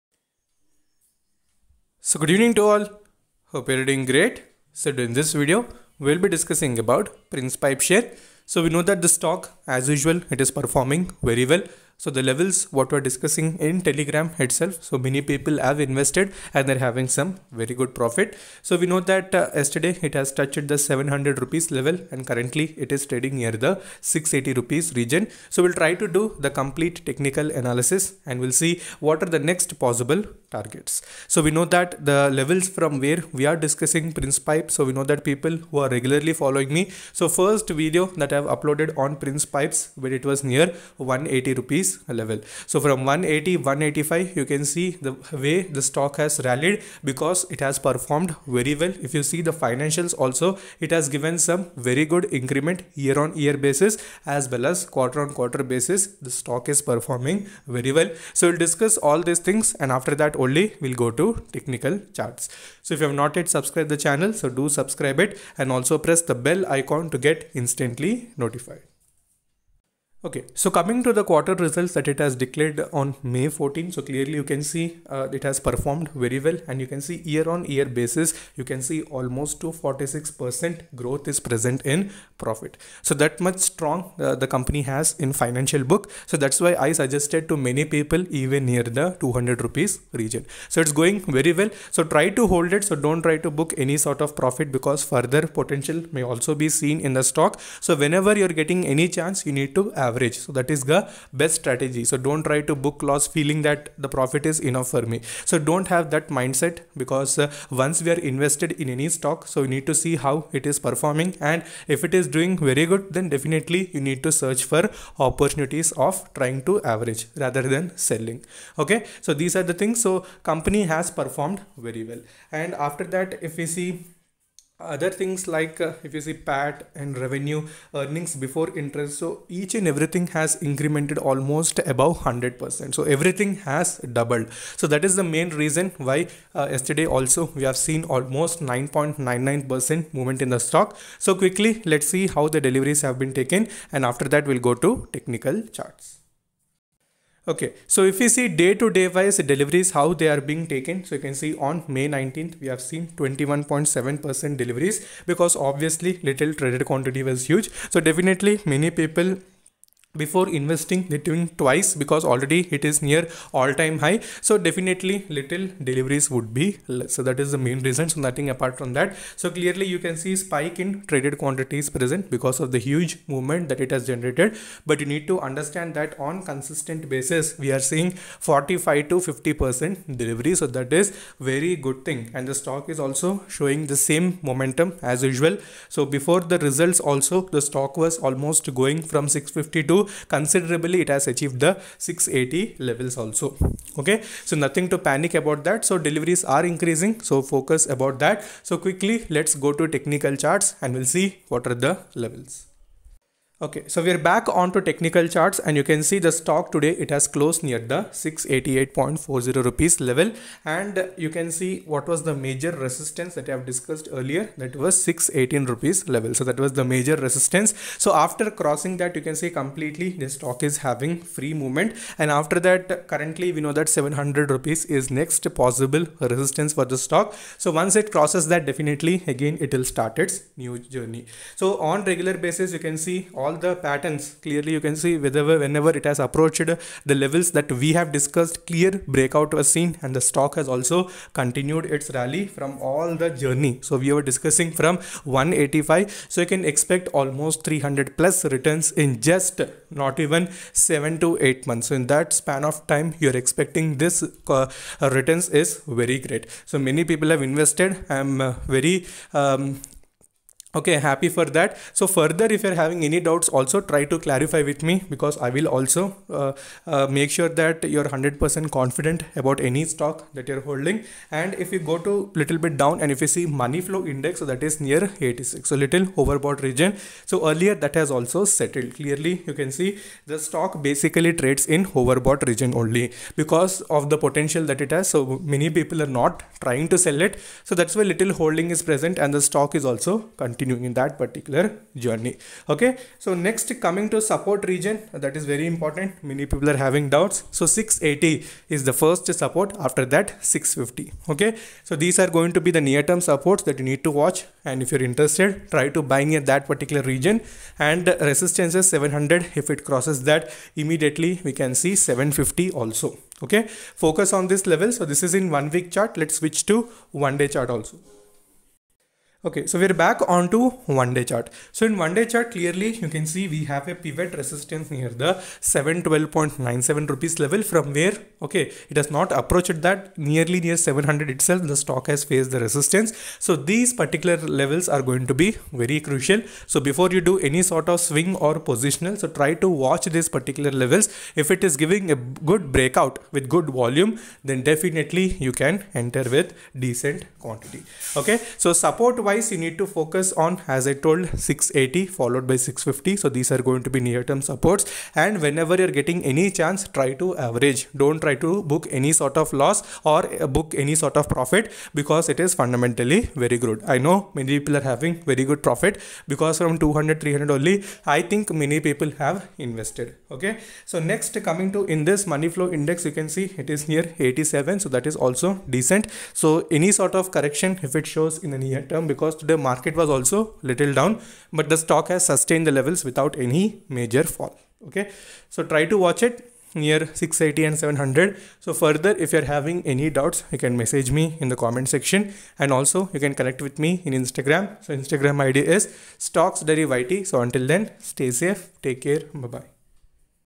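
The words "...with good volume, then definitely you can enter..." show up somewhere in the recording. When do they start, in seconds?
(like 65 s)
343 s.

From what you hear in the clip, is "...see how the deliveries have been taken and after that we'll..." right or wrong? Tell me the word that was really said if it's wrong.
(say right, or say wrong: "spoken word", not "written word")
right.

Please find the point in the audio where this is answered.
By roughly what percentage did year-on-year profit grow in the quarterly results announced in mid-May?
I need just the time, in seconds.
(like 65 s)
79 s.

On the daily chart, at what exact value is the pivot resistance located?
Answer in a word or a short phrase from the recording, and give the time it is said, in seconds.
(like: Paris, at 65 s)
712.97 rupees, at 325 s.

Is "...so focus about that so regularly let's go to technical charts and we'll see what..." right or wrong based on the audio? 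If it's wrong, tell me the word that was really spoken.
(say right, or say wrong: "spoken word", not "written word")
wrong: "quickly", not "regularly".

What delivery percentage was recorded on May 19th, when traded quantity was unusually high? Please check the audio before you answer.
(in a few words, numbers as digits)
21.7%.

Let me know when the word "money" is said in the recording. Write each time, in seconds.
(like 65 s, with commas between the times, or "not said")
273 s, 372 s.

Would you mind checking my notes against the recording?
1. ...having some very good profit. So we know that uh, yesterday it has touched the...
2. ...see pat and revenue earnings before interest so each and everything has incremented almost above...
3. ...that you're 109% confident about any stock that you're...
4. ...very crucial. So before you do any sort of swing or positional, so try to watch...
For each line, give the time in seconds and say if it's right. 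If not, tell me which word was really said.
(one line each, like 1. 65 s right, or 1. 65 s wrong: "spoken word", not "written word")
1. 16 s right
2. 126 s right
3. 267 s wrong: "100", not "109"
4. 335 s right.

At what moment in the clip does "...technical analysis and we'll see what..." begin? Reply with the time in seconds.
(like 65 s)
27 s.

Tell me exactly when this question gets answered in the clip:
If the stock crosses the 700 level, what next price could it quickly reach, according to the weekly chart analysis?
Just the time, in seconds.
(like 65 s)
312 s.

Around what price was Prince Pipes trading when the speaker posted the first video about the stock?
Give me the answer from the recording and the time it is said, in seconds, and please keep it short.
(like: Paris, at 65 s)
180 rupees, at 40 s.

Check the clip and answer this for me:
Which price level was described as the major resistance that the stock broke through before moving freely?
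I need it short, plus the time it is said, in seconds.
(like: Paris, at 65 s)
618 rupees, at 215 s.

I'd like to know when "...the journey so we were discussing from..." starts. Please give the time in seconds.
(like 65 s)
243 s.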